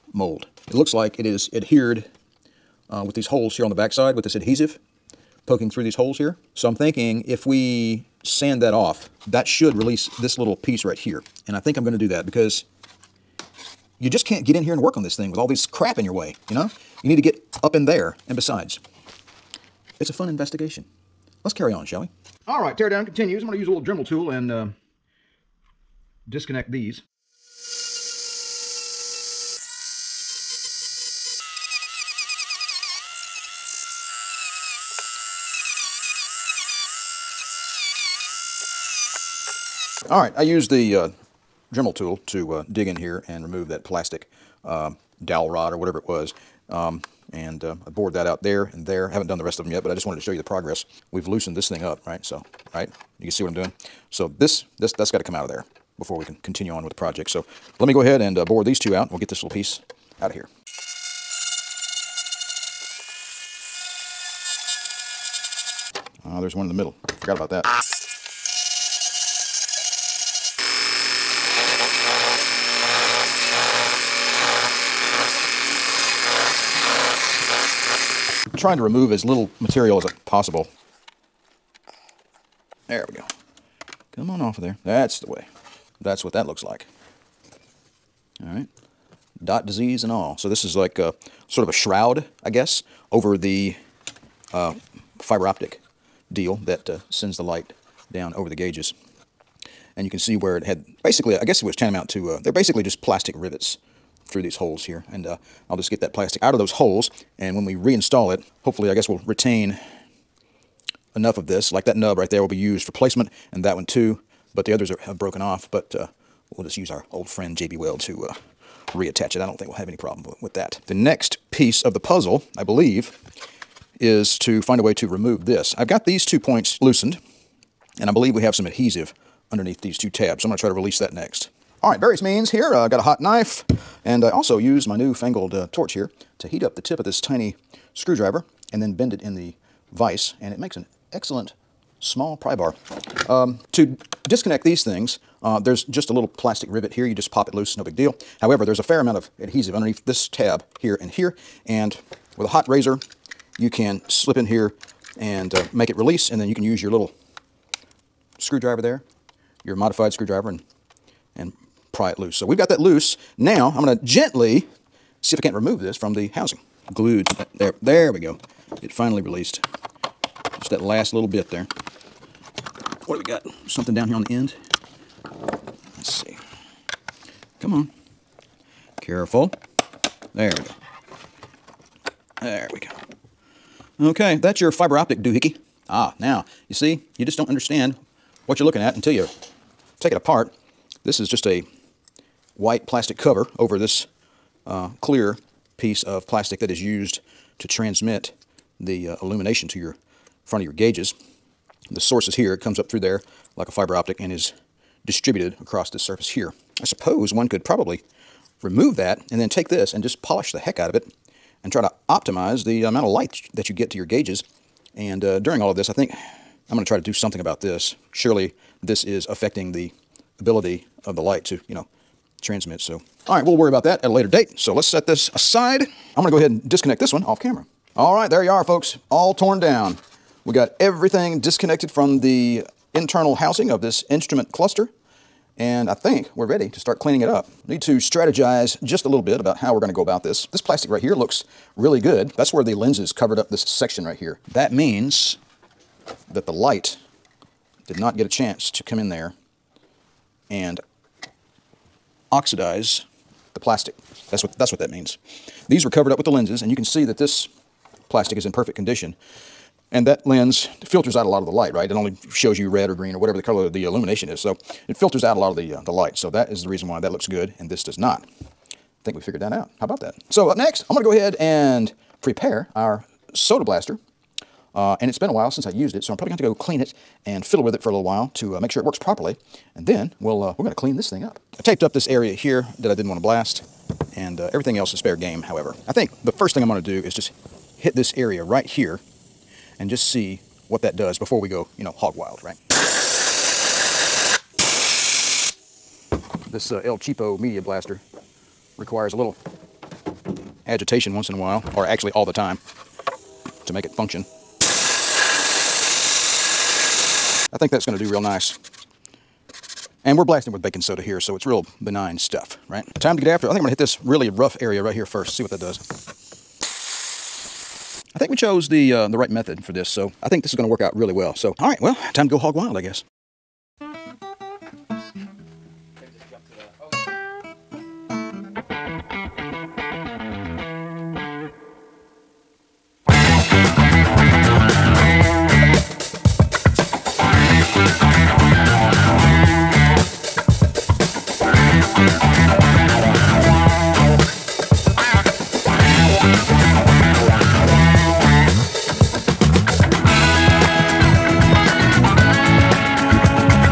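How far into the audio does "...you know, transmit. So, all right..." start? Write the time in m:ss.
3:41.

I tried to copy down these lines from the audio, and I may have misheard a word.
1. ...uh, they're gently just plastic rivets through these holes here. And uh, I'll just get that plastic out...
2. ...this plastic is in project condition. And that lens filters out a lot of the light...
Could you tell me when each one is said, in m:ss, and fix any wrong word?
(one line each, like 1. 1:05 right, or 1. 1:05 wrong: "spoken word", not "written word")
1. 1:42 wrong: "basically", not "gently"
2. 4:17 wrong: "perfect", not "project".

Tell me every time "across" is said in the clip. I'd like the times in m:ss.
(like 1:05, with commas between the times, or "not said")
3:25.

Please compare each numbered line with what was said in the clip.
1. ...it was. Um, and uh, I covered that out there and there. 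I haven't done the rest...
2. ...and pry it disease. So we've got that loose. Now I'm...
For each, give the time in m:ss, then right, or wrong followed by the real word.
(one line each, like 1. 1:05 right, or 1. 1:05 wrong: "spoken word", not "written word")
1. 0:45 wrong: "bored", not "covered"
2. 2:41 wrong: "loose", not "disease".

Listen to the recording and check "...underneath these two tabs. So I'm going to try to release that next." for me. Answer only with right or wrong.
right.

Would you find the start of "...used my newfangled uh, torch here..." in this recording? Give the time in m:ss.
2:14.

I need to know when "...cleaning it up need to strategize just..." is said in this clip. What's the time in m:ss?
3:57.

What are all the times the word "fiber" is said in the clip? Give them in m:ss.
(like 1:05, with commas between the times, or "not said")
1:35, 3:04, 3:23.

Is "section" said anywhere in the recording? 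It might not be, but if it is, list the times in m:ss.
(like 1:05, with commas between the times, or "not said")
4:03.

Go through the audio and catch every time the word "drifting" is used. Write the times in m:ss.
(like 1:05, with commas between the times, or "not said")
not said.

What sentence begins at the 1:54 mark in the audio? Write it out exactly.
But the others are, have broken off.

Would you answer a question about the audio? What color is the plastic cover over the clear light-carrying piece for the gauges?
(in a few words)
white.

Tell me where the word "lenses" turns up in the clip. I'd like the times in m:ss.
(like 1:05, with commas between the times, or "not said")
4:02, 4:16.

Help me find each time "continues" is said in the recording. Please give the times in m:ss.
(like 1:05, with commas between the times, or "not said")
0:23, 0:56.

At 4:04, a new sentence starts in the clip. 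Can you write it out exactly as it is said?
That means that the light did not get a chance to come in there and oxidize the plastic.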